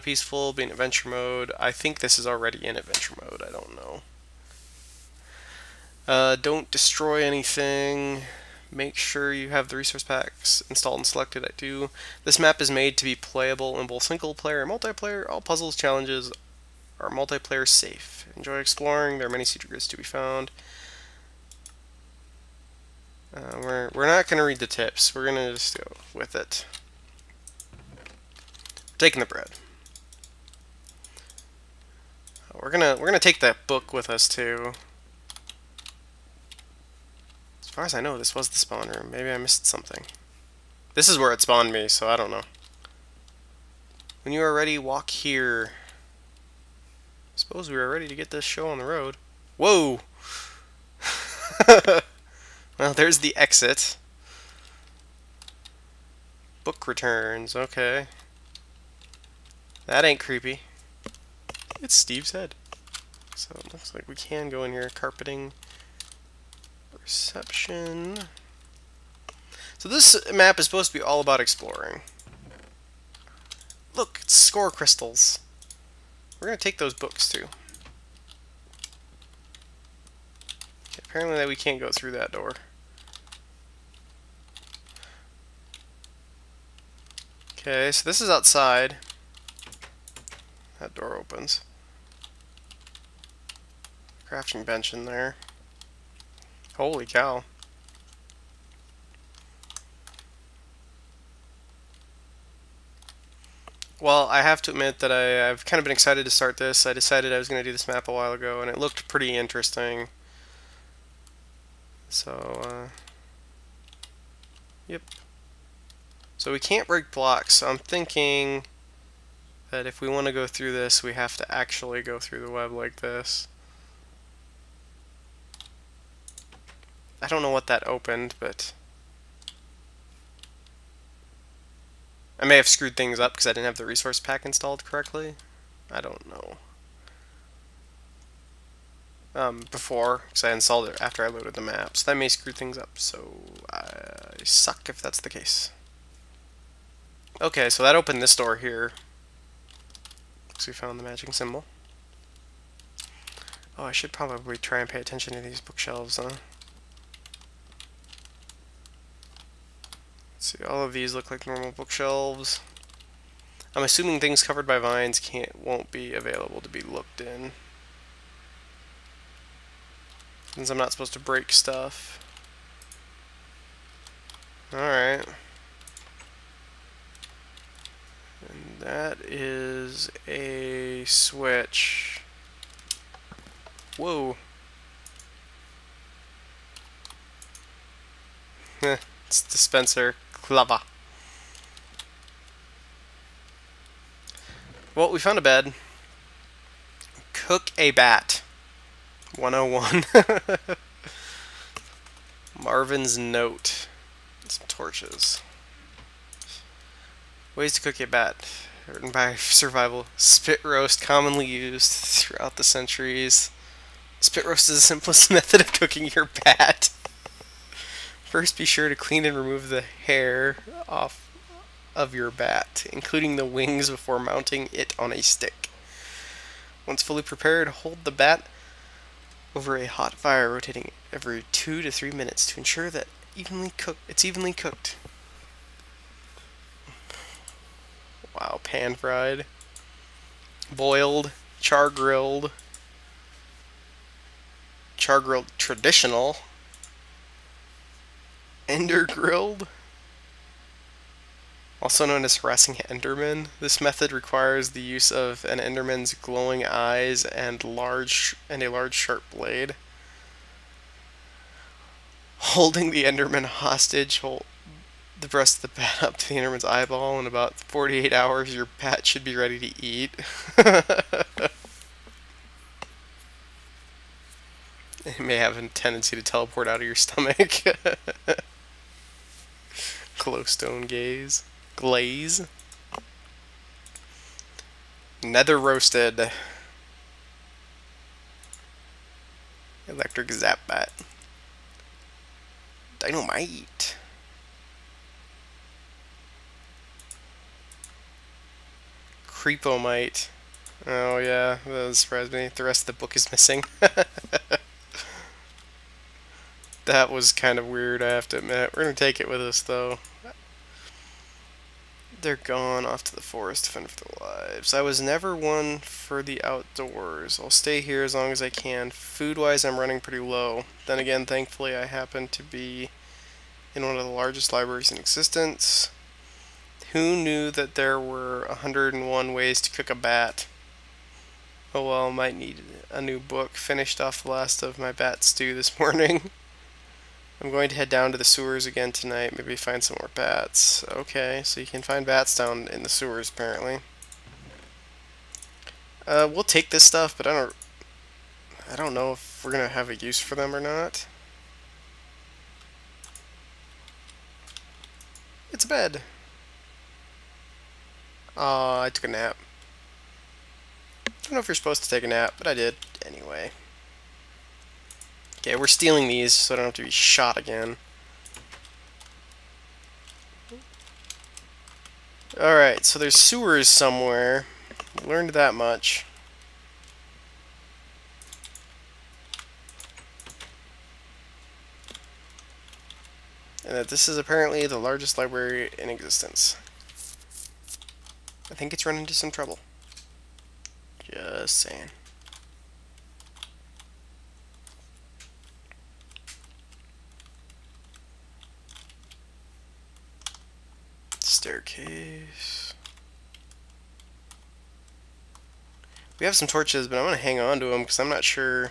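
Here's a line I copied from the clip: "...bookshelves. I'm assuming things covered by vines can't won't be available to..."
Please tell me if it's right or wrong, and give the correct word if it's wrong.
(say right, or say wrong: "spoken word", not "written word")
right.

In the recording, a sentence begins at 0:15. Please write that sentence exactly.
All puzzles, challenges are multiplayer safe.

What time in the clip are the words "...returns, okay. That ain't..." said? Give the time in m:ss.
0:56.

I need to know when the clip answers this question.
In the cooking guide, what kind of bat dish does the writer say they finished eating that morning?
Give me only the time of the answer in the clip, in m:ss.
5:34.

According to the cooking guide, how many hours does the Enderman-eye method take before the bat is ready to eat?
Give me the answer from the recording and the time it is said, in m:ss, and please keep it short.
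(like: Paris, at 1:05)
48, at 4:27.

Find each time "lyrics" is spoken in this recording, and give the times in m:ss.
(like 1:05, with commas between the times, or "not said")
not said.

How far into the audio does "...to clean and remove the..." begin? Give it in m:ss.
3:38.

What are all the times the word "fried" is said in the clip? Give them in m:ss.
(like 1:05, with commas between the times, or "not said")
3:58.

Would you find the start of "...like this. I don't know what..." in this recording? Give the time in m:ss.
2:02.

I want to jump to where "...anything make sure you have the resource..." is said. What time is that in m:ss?
0:07.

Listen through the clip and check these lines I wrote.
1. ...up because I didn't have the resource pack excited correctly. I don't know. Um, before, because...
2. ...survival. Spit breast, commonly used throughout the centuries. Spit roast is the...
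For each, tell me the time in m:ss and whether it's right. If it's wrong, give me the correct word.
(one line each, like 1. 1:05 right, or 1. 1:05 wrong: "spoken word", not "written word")
1. 2:13 wrong: "installed", not "excited"
2. 3:29 wrong: "roast", not "breast".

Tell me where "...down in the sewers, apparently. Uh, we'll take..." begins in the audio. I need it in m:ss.
5:42.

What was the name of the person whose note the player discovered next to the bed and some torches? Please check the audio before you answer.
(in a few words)
Marvin.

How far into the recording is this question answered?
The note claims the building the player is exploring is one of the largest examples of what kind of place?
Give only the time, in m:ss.
5:24.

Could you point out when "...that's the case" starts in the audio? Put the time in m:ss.
2:25.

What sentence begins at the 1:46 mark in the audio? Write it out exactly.
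I decided I was going to do this map a while ago, and it looked pretty interesting.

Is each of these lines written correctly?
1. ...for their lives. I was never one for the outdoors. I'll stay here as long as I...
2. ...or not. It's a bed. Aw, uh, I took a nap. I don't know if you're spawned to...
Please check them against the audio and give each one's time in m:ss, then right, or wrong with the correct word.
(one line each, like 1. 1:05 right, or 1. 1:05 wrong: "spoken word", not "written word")
1. 5:13 right
2. 5:50 wrong: "supposed", not "spawned".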